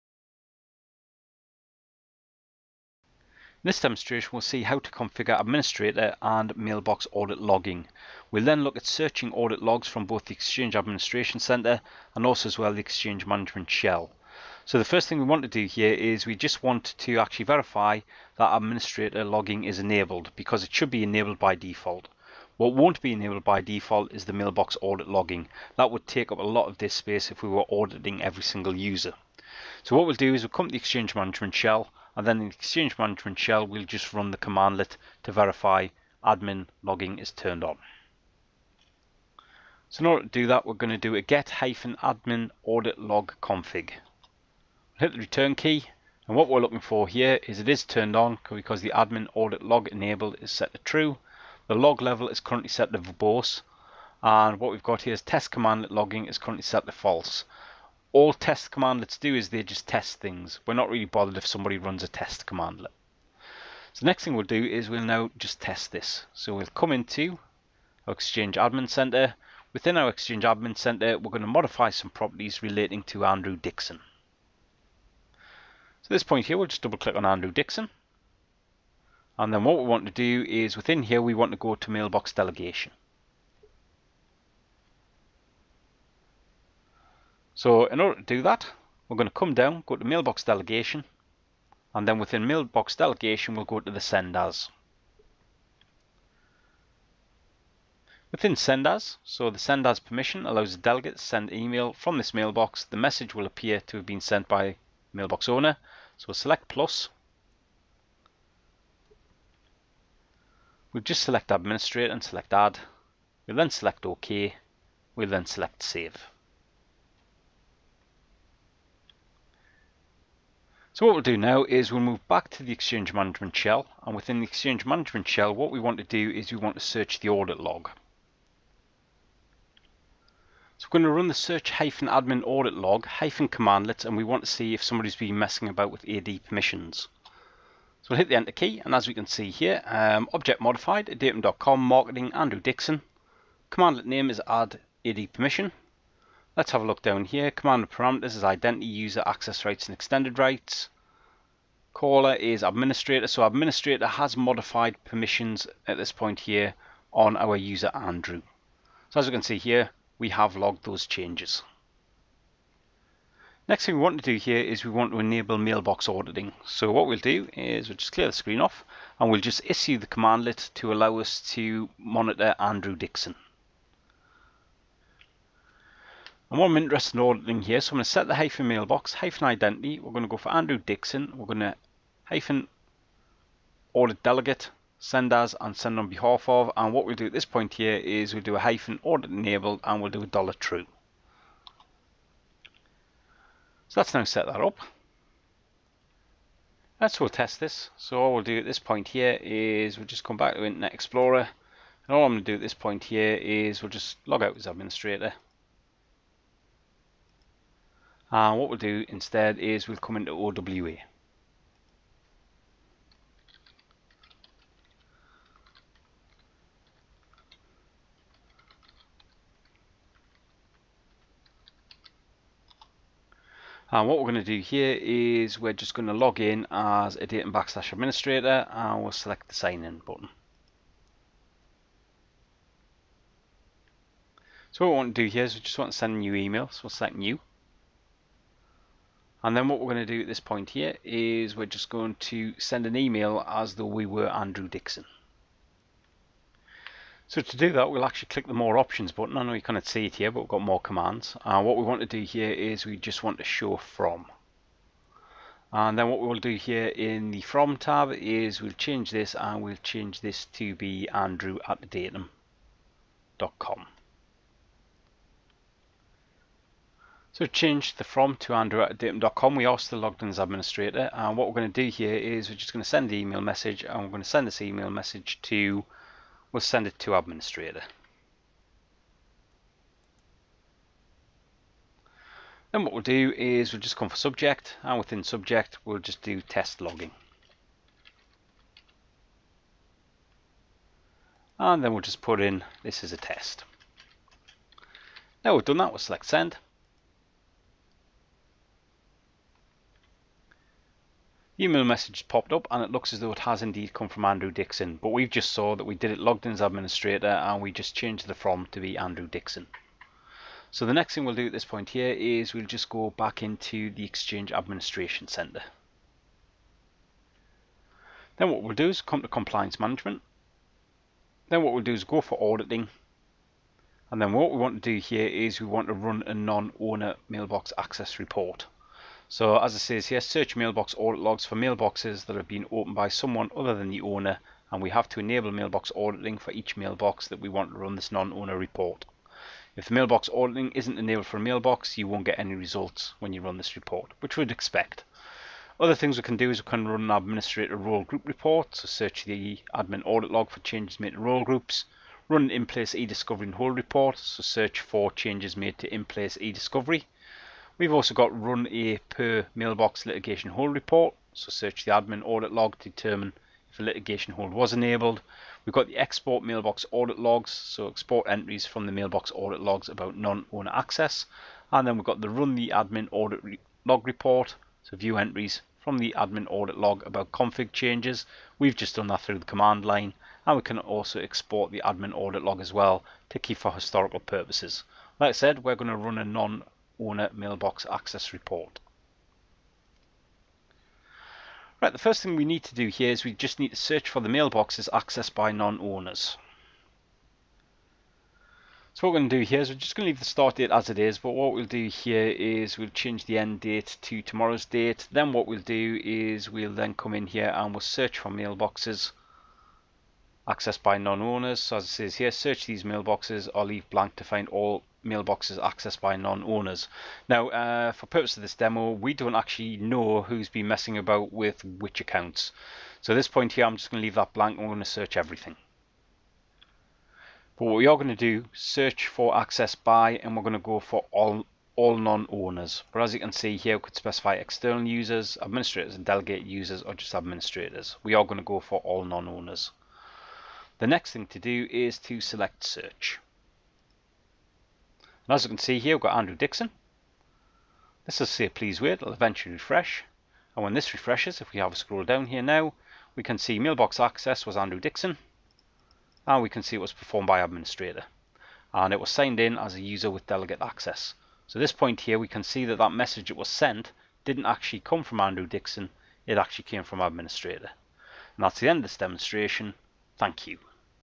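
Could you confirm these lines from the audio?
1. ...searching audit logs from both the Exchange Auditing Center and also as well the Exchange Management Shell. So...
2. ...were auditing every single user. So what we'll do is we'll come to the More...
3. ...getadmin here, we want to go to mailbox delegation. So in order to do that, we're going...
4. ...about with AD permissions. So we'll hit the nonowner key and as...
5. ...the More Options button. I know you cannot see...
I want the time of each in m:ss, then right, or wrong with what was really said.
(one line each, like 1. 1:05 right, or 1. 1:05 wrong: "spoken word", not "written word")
1. 0:08 wrong: "Administration", not "Auditing"
2. 0:27 wrong: "Exchange", not "More"
3. 1:20 wrong: "within", not "getadmin"
4. 2:15 wrong: "enter", not "nonowner"
5. 4:08 right.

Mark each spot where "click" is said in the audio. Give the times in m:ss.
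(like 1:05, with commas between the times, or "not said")
1:16, 4:08.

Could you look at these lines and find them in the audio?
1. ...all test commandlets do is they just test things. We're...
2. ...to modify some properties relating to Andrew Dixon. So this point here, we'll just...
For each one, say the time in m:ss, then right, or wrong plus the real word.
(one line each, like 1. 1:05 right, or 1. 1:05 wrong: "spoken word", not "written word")
1. 0:58 right
2. 1:11 right.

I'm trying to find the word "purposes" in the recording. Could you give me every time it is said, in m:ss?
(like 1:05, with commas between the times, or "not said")
6:24, 6:58.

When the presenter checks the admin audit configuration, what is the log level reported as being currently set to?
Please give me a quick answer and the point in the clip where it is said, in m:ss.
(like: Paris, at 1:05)
Verbose, at 0:52.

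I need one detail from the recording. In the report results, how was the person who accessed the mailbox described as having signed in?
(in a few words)
As a user with delegate access.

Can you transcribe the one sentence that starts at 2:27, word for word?
Command parameters is identity, user access rights and extended rights caller is administrator.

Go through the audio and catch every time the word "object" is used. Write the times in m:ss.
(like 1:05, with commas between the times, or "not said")
2:20.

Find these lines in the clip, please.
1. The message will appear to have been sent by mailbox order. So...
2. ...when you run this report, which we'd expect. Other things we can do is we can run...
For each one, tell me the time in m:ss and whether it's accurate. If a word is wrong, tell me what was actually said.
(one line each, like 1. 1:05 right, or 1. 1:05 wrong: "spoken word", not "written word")
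1. 1:42 wrong: "owner", not "order"
2. 5:43 right.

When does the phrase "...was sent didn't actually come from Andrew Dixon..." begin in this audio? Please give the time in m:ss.
7:43.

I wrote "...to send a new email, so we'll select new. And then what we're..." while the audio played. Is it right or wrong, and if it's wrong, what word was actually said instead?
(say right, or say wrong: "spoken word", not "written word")
right.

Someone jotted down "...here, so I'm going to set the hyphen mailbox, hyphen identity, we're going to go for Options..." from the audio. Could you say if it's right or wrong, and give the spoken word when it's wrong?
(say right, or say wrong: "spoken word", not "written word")
wrong: "Andrew", not "Options".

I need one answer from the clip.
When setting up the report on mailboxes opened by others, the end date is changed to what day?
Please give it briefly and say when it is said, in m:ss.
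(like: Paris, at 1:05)
Tomorrow, at 6:44.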